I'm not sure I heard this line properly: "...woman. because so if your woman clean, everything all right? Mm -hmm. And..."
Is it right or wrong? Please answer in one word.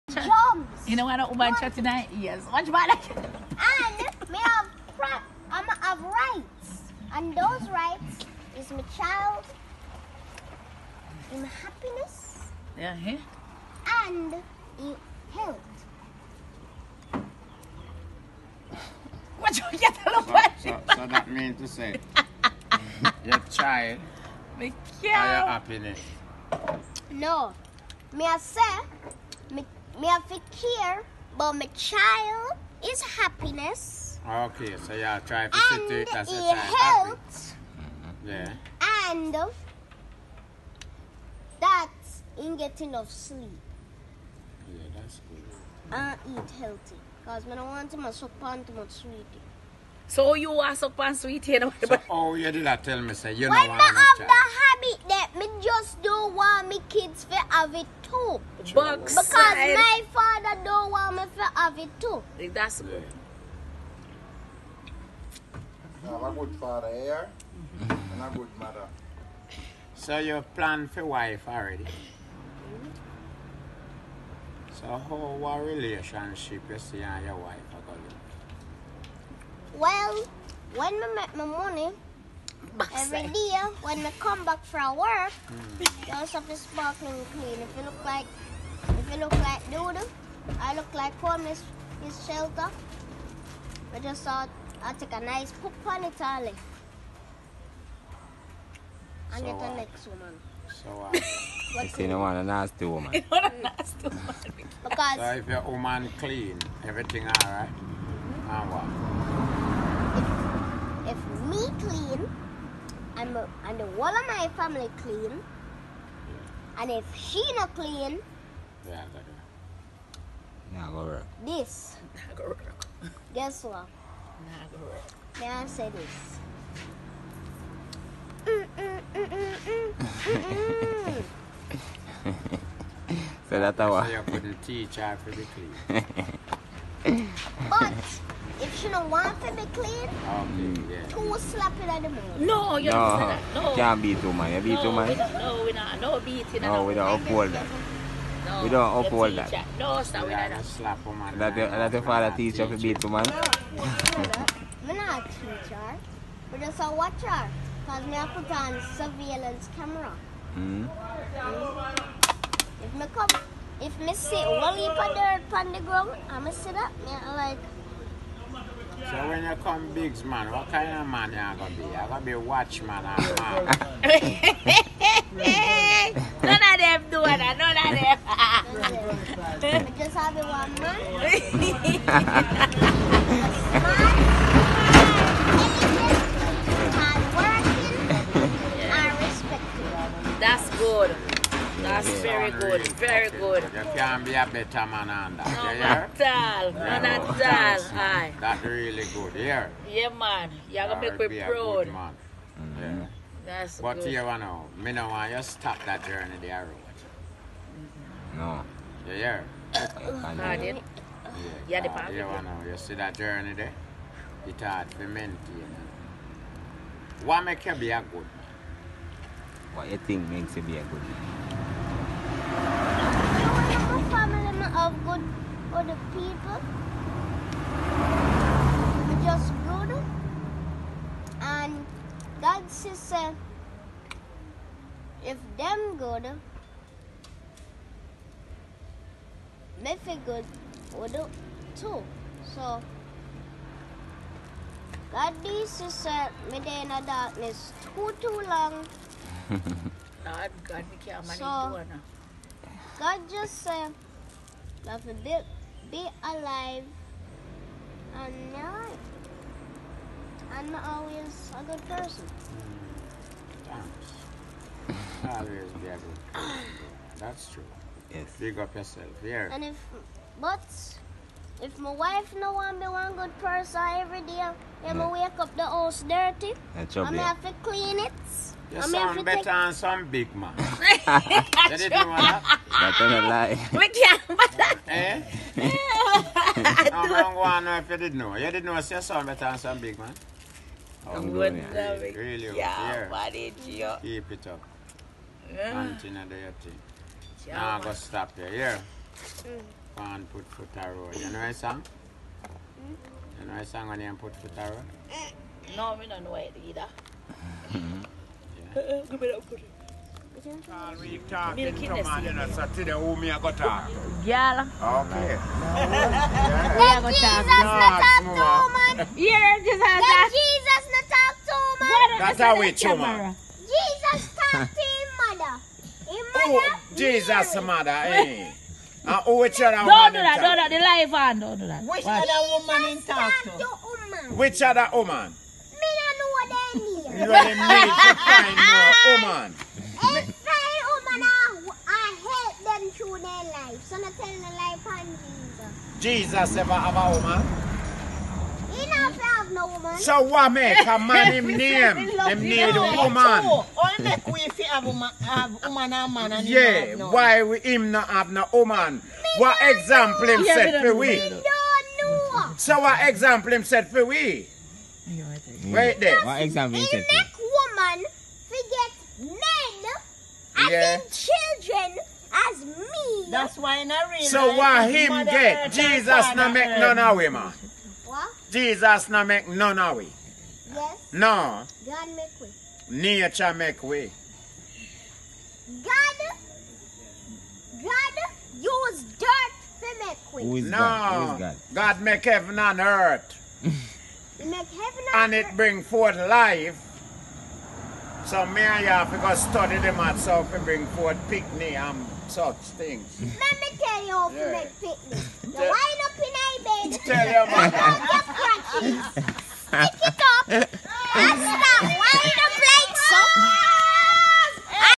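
right.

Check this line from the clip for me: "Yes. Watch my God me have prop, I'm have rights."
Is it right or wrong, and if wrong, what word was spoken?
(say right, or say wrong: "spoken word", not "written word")
wrong: "And", not "God".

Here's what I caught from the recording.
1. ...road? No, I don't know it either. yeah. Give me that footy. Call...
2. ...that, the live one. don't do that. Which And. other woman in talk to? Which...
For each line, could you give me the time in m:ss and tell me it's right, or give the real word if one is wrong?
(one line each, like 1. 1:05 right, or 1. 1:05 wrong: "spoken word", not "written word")
1. 5:04 right
2. 5:30 wrong: "Watch", not "And".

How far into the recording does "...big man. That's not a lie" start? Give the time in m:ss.
4:40.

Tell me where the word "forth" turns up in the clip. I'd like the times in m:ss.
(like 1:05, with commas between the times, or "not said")
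6:35, 6:40.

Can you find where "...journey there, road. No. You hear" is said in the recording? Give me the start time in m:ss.
3:26.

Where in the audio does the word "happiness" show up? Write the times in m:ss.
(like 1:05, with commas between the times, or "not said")
0:11, 0:25, 0:33.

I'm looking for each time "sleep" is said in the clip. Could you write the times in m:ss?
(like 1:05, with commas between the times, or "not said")
0:43.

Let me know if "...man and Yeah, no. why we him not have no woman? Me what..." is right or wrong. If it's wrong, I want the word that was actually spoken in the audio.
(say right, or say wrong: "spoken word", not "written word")
right.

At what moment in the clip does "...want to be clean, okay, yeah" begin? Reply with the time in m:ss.
2:19.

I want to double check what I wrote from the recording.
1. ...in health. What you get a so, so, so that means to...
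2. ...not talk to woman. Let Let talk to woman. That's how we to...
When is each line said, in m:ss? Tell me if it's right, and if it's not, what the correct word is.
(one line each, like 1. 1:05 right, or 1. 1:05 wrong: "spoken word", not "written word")
1. 0:14 right
2. 5:17 wrong: "Jesus", not "Let".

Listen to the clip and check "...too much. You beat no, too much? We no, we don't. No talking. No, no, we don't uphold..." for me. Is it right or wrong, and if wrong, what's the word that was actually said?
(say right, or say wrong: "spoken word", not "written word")
wrong: "beating", not "talking".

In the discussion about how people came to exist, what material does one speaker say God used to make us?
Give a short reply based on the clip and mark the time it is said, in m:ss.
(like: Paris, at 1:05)
dirt, at 6:29.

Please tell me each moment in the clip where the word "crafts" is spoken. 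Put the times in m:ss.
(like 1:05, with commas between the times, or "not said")
not said.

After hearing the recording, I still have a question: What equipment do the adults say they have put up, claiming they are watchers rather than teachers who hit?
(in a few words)
surveillance camera.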